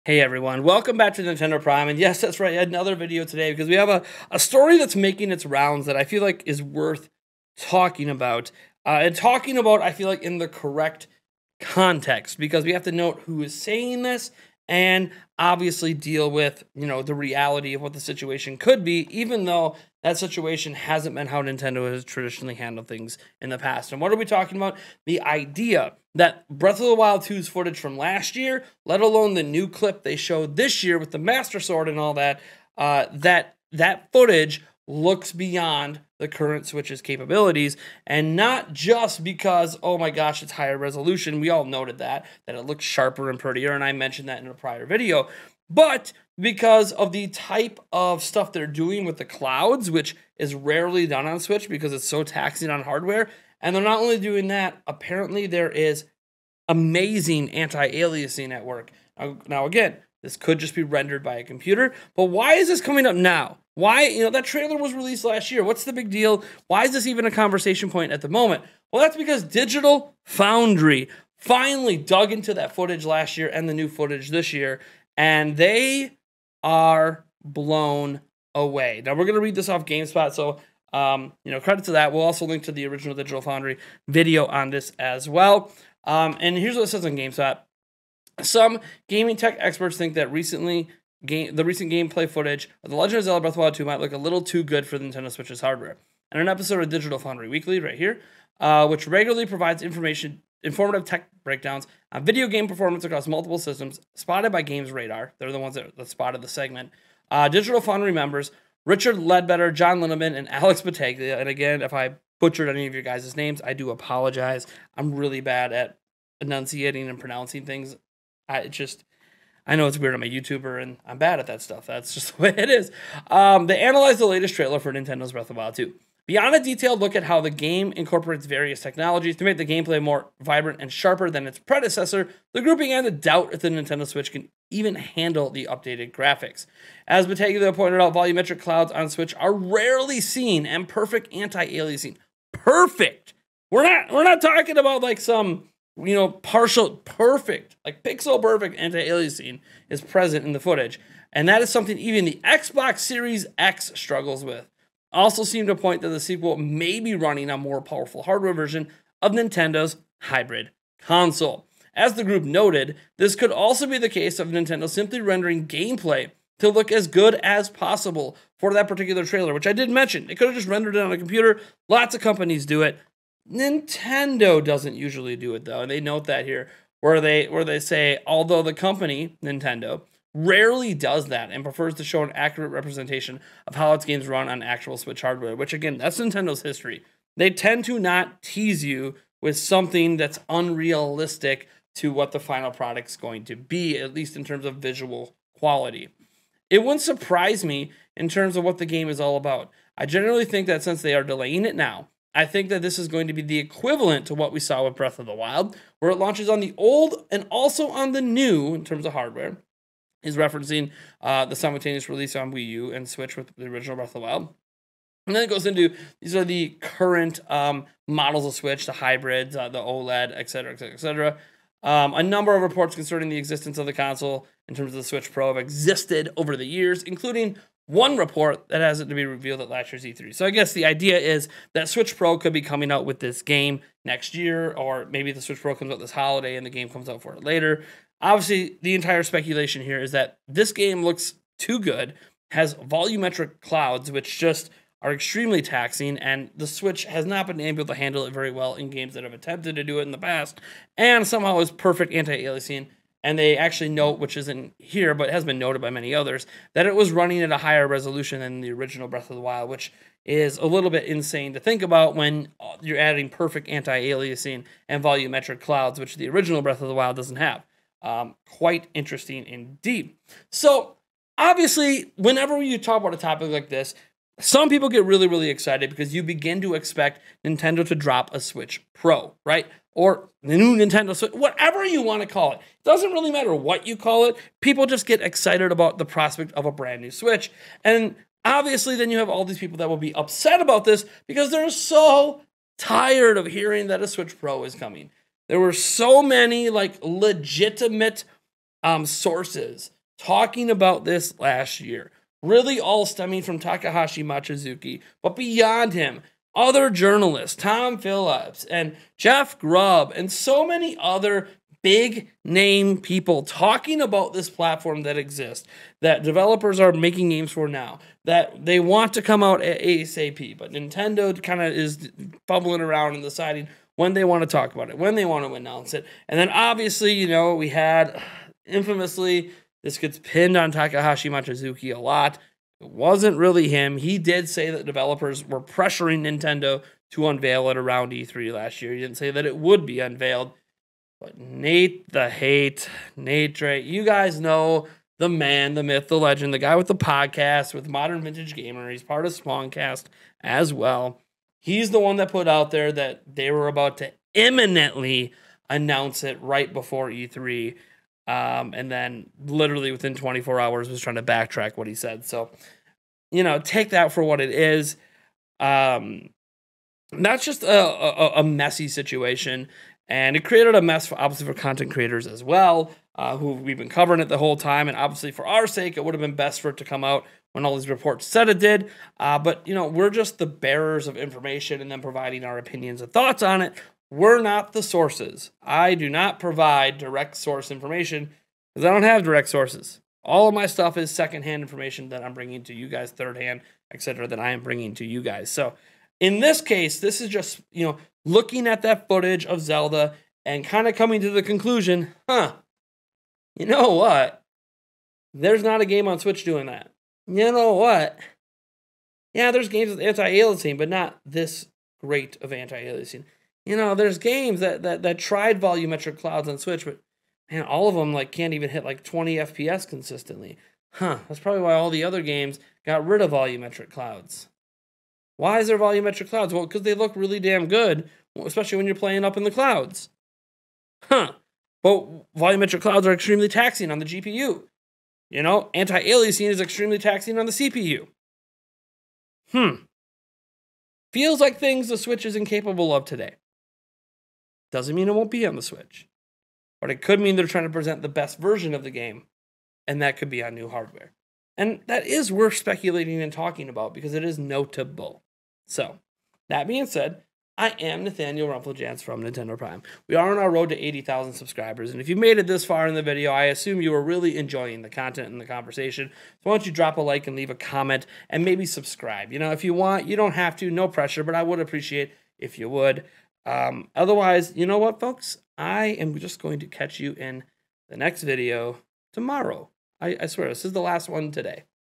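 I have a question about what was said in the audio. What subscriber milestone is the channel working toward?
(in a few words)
80,000.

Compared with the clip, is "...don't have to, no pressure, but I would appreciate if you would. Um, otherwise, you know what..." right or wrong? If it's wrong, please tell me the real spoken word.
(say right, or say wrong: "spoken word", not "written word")
right.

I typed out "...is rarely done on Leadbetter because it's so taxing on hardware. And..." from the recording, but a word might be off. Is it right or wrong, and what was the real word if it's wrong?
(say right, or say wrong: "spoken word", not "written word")
wrong: "Switch", not "Leadbetter".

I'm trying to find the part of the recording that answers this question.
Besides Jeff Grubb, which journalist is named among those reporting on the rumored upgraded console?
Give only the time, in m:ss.
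5:07.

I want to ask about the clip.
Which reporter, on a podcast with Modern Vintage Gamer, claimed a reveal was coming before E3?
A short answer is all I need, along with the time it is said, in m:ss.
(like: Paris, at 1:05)
Nate Drake, at 5:43.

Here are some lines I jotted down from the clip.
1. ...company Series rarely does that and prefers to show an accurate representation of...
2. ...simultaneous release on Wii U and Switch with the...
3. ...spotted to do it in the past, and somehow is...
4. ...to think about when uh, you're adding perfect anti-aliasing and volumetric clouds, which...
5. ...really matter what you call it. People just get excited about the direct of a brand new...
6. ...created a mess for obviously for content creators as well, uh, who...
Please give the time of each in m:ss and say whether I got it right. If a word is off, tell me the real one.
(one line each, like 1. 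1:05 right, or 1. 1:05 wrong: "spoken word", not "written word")
1. 2:58 wrong: "Nintendo", not "Series"
2. 3:31 right
3. 4:09 wrong: "attempted", not "spotted"
4. 4:21 right
5. 4:43 wrong: "prospect", not "direct"
6. 6:10 right.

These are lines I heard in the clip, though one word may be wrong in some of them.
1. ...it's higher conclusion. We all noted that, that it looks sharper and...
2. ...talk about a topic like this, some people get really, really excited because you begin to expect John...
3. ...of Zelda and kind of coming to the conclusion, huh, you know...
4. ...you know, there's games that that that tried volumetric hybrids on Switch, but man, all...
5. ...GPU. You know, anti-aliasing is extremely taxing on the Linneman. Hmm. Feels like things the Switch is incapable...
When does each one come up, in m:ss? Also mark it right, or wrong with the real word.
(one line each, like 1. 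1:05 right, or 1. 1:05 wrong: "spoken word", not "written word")
1. 0:40 wrong: "resolution", not "conclusion"
2. 4:32 wrong: "Nintendo", not "John"
3. 6:39 right
4. 6:53 wrong: "clouds", not "hybrids"
5. 7:14 wrong: "CPU", not "Linneman".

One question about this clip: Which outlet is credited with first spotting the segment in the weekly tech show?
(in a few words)
Games Radar.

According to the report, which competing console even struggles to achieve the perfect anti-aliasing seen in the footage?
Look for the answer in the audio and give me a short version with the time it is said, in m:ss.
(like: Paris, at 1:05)
Xbox Series X, at 2:32.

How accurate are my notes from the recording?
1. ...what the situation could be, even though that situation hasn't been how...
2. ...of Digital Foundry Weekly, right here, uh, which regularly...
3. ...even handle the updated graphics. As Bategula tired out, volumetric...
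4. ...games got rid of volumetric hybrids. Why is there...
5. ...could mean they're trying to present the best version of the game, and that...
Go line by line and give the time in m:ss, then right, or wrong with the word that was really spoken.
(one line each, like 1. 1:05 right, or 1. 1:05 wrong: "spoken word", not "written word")
1. 0:17 right
2. 1:36 right
3. 2:14 wrong: "pointed", not "tired"
4. 7:02 wrong: "clouds", not "hybrids"
5. 7:27 right.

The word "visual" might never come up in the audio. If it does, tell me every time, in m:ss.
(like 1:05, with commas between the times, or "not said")
3:14.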